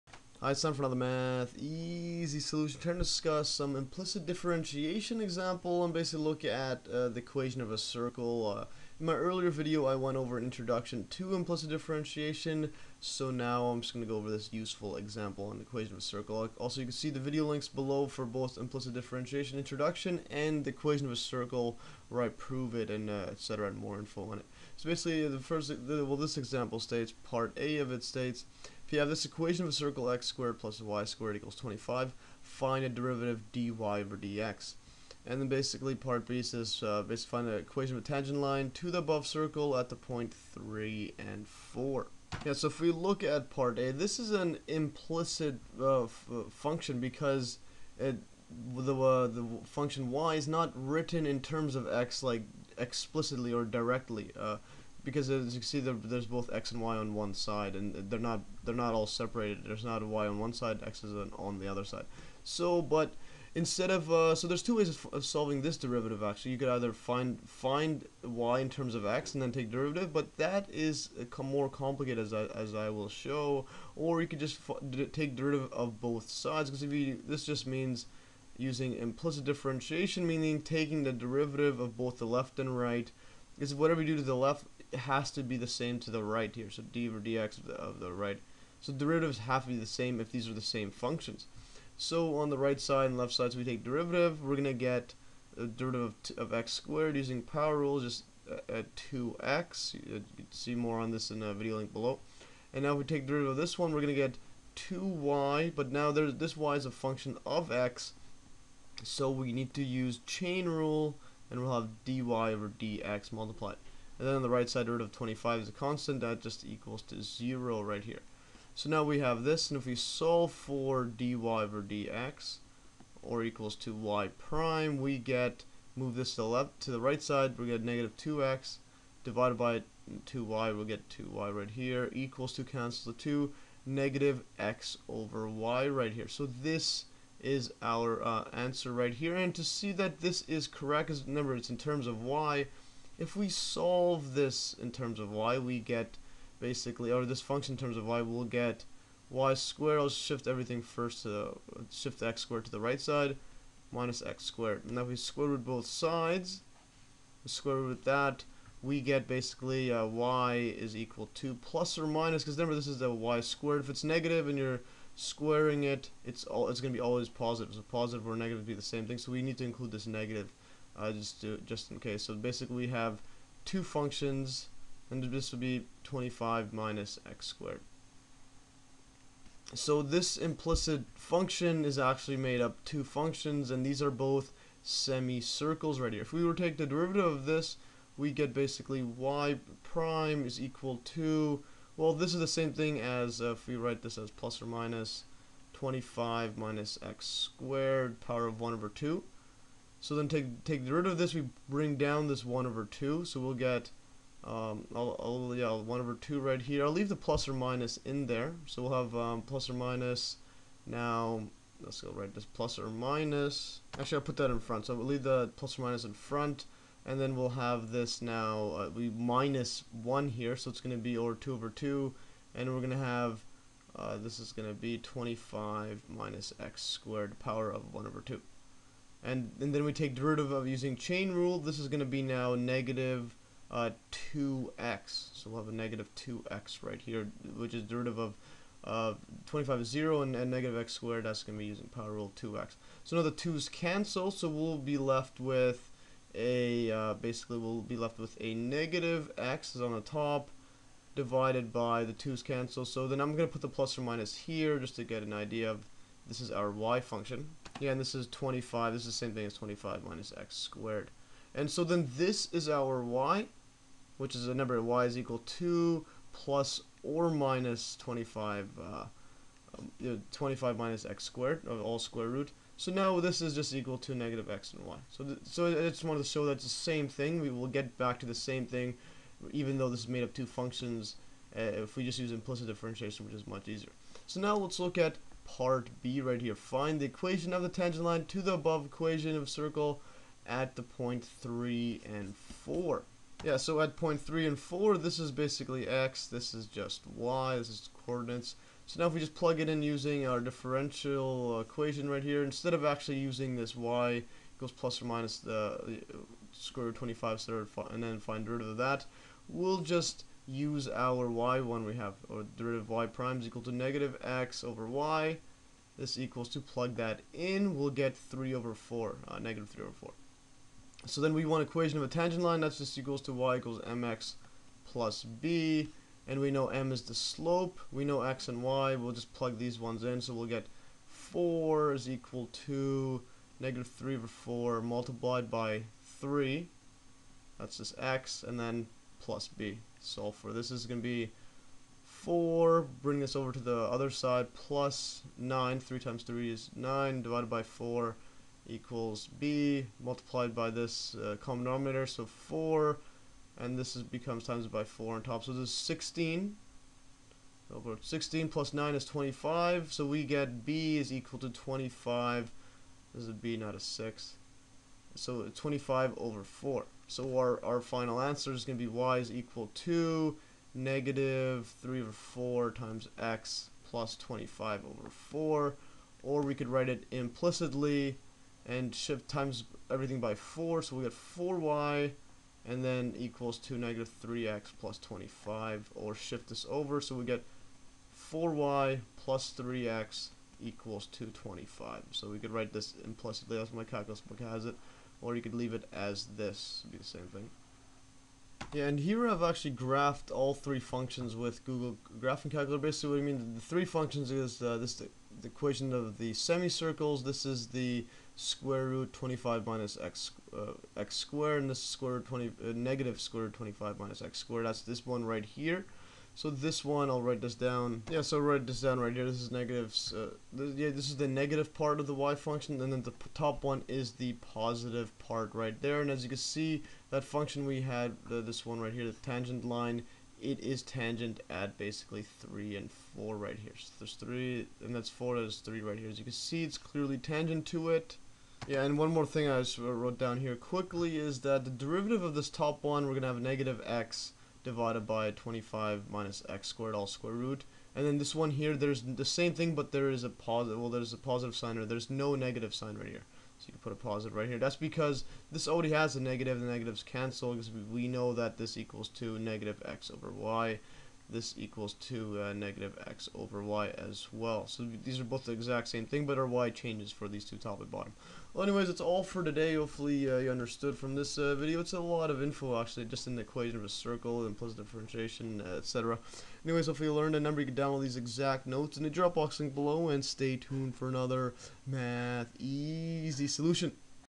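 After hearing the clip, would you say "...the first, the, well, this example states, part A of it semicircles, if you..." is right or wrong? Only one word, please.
wrong.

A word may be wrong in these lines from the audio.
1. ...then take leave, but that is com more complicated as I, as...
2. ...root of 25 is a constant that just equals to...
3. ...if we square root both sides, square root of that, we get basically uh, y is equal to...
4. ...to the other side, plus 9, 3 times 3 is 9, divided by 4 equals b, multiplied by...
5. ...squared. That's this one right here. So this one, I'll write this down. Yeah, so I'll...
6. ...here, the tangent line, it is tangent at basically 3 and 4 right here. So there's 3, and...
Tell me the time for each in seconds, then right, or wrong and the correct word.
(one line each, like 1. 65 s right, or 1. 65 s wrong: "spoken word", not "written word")
1. 69 s wrong: "derivative", not "leave"
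2. 114 s right
3. 154 s right
4. 343 s right
5. 414 s right
6. 428 s right.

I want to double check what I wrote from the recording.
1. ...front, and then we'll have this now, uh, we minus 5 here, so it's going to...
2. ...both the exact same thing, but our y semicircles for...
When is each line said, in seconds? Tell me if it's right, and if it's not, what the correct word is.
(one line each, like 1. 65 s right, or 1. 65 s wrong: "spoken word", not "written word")
1. 216 s wrong: "1", not "5"
2. 465 s wrong: "changes", not "semicircles".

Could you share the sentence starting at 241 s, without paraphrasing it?
That's going to be using power rule 2x.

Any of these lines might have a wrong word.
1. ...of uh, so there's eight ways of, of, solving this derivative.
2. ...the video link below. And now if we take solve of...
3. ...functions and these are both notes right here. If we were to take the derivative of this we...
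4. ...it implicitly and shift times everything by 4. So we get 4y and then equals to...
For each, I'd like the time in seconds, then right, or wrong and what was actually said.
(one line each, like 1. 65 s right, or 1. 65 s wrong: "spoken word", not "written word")
1. 63 s wrong: "two", not "eight"
2. 101 s wrong: "derivative", not "solve"
3. 183 s wrong: "semicircles", not "notes"
4. 376 s right.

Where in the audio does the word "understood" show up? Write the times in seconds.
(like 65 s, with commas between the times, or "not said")
470 s.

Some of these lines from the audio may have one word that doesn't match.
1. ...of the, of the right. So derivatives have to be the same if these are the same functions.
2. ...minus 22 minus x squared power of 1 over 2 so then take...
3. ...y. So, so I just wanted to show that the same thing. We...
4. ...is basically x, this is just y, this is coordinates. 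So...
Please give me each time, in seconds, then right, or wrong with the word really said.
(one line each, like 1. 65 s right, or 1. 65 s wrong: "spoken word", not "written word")
1. 87 s right
2. 194 s wrong: "25", not "22"
3. 274 s right
4. 295 s right.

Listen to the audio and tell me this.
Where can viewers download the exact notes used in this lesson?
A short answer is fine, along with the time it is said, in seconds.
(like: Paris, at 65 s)
Dropbox link, at 479 s.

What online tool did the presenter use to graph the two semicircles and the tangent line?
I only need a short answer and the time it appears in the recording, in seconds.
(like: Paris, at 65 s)
Google Graphing Calculator, at 401 s.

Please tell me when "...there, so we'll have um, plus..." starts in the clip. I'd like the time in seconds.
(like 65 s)
208 s.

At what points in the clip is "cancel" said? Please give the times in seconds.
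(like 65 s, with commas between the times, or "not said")
132 s, 243 s, 252 s, 457 s.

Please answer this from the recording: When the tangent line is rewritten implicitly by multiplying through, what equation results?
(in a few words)
4y + 3x = 25.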